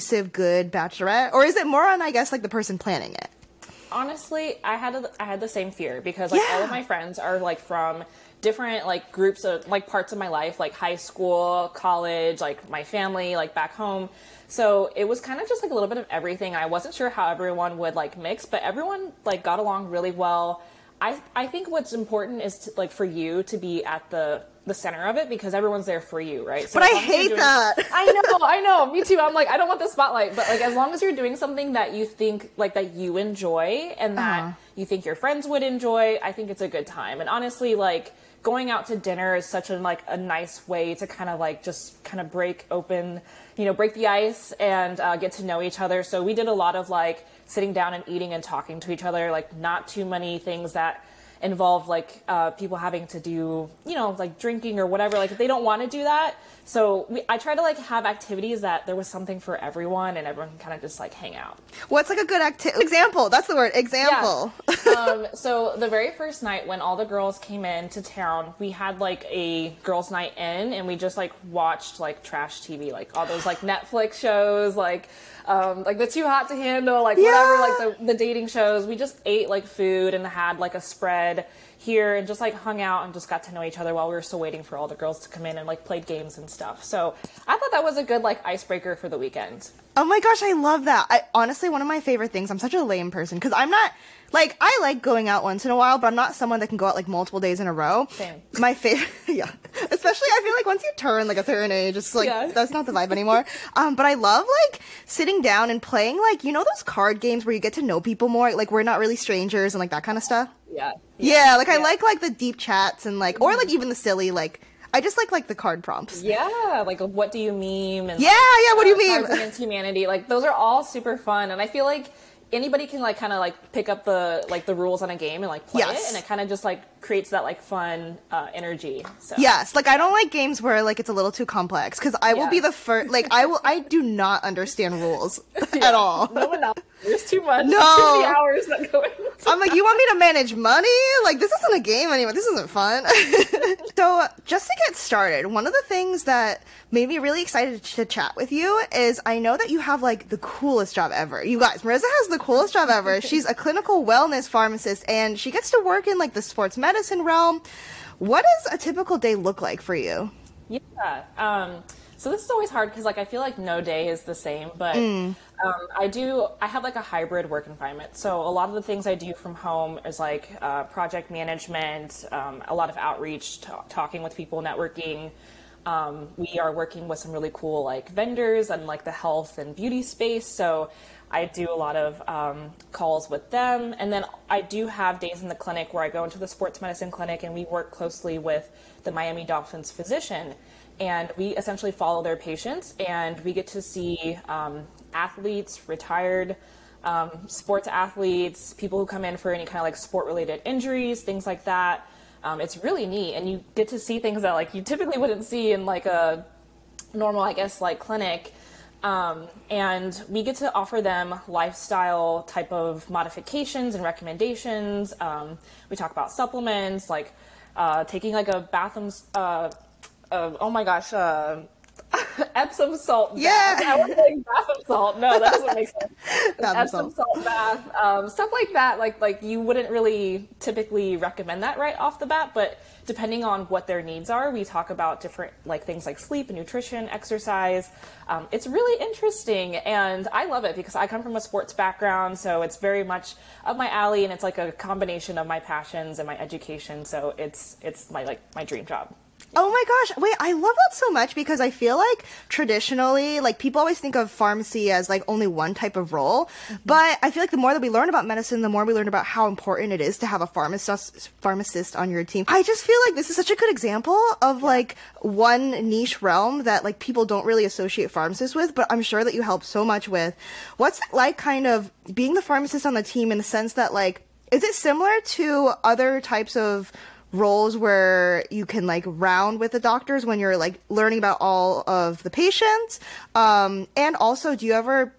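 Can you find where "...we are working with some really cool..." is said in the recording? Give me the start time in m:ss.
2:56.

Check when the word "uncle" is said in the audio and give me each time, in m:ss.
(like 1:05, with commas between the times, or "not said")
not said.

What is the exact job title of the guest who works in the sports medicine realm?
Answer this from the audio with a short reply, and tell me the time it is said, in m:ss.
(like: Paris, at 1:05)
Clinical wellness pharmacist, at 2:33.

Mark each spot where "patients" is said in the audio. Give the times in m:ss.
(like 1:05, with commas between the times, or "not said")
3:12, 4:42.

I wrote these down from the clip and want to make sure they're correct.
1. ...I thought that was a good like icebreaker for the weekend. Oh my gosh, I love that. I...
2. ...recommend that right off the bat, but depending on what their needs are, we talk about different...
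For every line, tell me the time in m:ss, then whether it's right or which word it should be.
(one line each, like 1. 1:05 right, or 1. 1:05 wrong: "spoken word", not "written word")
1. 1:27 right
2. 3:51 right.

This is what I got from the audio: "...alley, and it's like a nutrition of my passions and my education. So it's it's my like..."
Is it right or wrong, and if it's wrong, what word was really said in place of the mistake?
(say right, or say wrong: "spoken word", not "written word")
wrong: "combination", not "nutrition".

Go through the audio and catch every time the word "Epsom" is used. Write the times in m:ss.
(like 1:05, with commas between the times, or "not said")
3:42, 3:46.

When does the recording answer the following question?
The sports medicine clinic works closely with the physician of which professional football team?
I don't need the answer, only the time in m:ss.
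3:09.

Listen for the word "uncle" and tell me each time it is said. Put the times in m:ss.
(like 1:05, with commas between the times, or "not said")
not said.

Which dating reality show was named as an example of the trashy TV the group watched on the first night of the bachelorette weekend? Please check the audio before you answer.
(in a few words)
Too Hot to Handle.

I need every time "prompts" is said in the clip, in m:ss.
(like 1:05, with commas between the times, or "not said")
1:55.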